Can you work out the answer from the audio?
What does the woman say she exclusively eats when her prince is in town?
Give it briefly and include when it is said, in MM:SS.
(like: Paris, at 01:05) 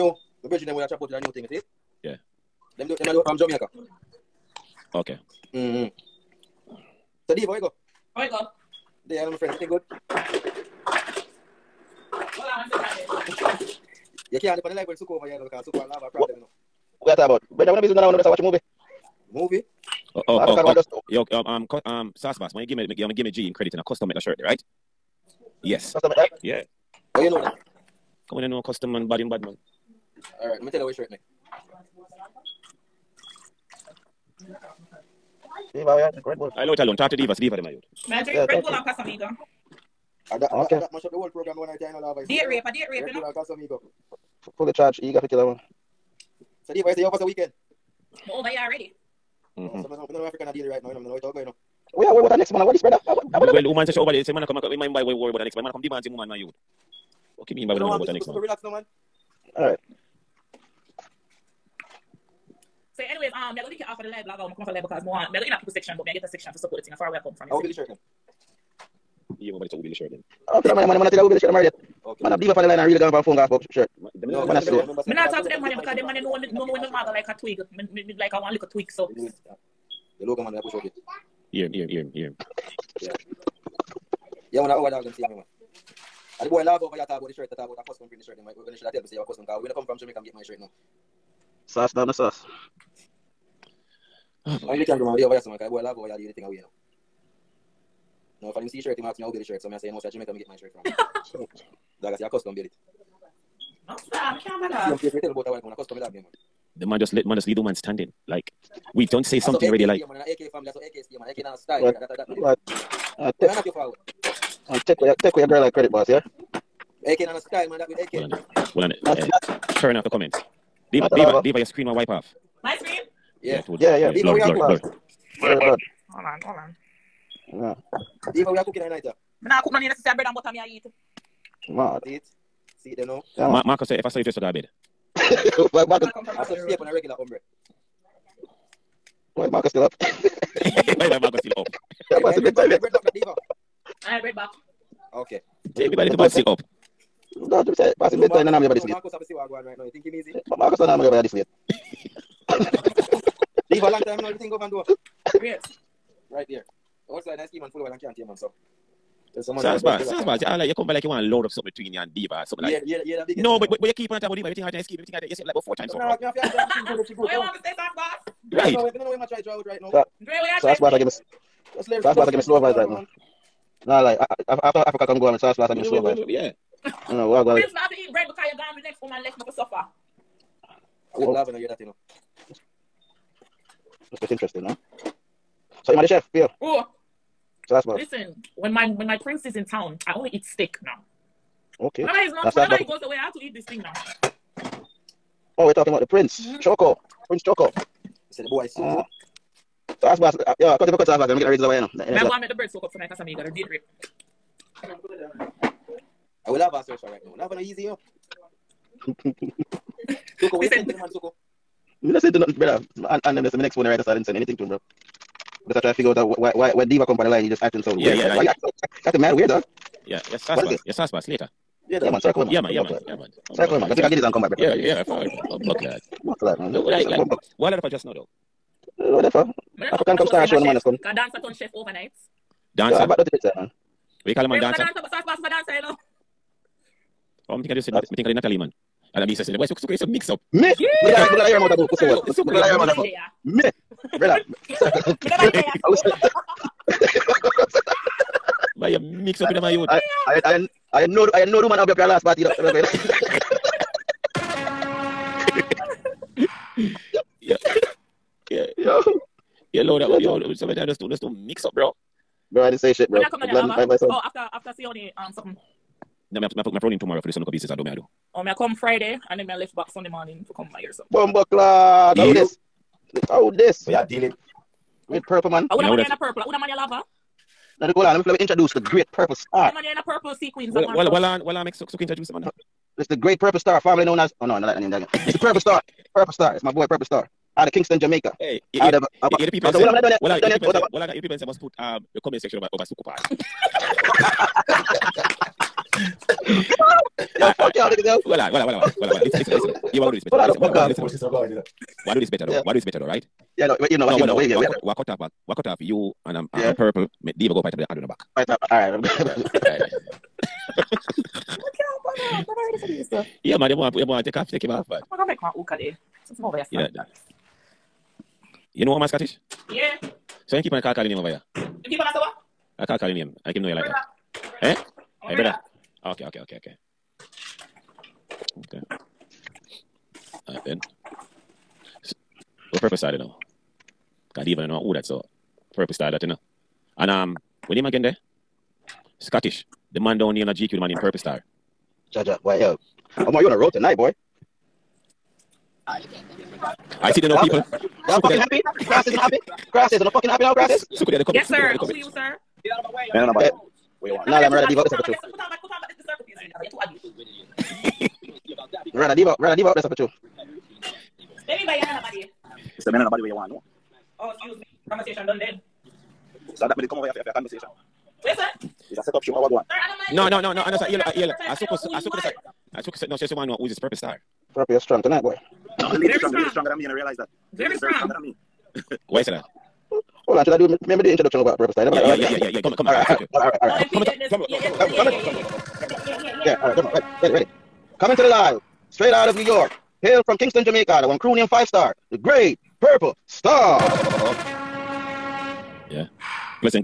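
steak, at 03:10.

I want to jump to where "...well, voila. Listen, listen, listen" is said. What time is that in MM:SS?
04:59.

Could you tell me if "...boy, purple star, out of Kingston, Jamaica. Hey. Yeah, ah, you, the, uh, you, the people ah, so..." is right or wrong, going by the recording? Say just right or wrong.
right.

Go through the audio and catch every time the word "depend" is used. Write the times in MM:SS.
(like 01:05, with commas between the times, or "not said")
00:14.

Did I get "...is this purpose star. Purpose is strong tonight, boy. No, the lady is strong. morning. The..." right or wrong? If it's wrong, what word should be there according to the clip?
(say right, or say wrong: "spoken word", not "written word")
wrong: "strong", not "morning".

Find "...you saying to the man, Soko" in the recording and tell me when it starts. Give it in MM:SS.
03:30.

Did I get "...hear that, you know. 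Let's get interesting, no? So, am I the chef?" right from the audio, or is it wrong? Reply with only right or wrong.
right.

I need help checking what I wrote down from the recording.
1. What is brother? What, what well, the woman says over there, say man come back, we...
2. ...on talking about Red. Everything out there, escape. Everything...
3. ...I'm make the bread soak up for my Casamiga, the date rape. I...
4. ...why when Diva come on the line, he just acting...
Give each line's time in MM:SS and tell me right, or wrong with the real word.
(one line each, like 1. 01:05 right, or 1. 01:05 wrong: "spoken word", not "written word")
1. 00:52 right
2. 02:44 wrong: "Diva", not "Red"
3. 03:22 right
4. 03:36 right.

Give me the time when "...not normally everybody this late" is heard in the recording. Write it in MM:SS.
02:30.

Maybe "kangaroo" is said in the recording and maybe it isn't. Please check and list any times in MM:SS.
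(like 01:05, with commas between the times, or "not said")
01:34.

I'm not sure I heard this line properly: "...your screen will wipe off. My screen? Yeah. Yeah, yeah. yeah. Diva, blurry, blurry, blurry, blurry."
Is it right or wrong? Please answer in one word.
right.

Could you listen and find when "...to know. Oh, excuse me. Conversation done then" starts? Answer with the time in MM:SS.
06:03.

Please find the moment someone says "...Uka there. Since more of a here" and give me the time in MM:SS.
05:15.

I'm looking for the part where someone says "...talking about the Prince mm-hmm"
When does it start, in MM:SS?
03:15.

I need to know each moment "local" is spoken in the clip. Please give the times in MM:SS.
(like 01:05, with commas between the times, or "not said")
01:20, 04:27.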